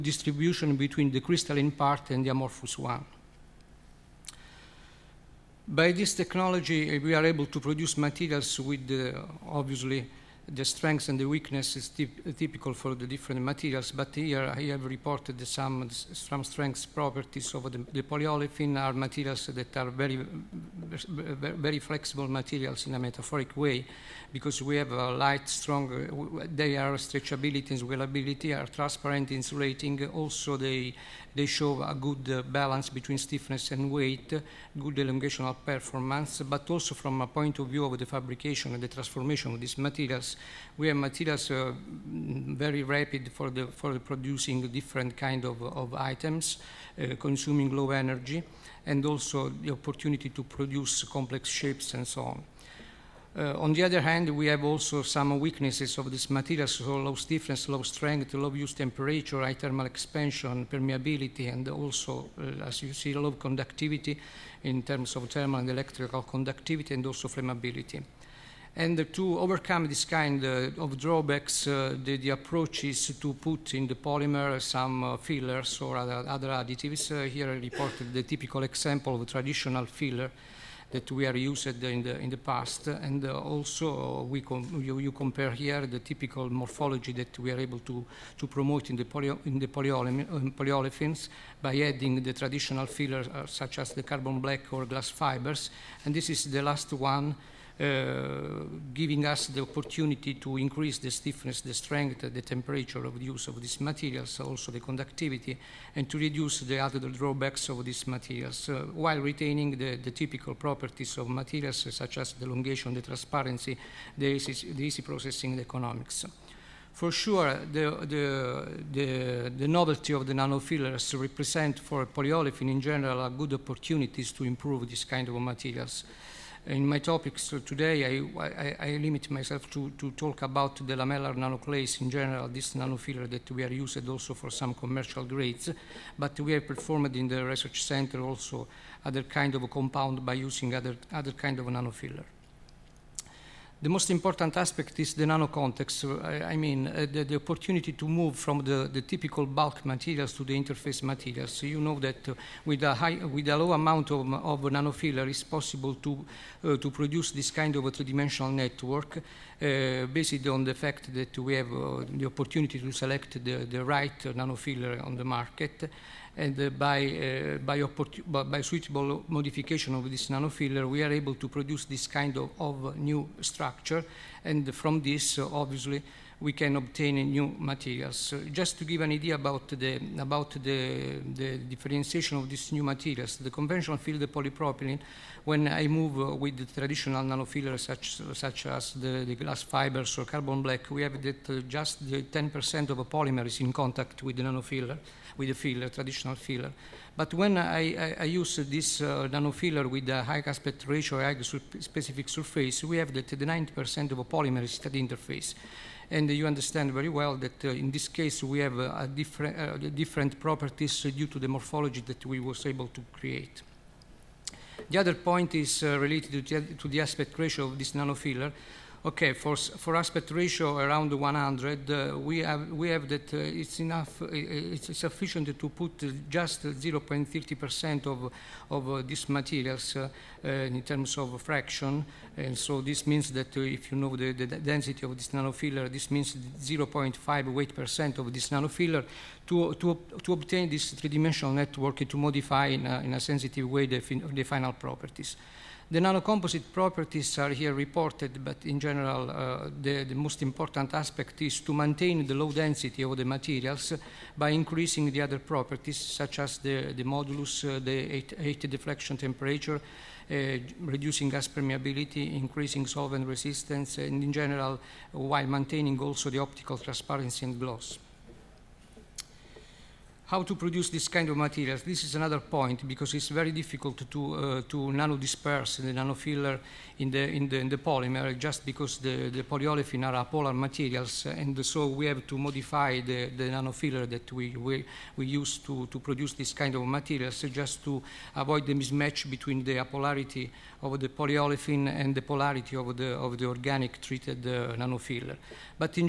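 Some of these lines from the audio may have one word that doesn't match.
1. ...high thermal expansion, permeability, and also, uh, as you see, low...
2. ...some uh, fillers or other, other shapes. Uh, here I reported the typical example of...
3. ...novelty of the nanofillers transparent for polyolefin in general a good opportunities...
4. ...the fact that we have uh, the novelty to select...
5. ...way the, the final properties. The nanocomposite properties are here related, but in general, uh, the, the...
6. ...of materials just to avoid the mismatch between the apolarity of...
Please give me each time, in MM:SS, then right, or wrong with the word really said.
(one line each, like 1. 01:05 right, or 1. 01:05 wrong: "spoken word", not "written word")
1. 00:59 right
2. 01:14 wrong: "additives", not "shapes"
3. 01:59 wrong: "represent", not "transparent"
4. 02:40 wrong: "opportunity", not "novelty"
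5. 04:03 wrong: "reported", not "related"
6. 04:46 right.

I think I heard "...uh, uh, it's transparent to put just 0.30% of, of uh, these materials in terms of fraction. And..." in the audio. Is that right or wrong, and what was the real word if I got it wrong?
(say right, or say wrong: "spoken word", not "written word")
wrong: "sufficient", not "transparent".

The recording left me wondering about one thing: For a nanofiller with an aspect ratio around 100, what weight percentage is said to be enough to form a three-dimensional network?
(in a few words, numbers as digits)
0.5 weight percent.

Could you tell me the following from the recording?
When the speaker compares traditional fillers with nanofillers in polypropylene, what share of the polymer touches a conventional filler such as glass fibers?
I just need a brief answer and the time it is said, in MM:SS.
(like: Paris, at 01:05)
10%, at 03:12.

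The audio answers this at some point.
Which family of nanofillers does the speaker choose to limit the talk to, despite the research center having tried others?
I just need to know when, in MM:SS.
02:10.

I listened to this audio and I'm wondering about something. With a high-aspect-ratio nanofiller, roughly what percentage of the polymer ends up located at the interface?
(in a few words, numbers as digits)
90%.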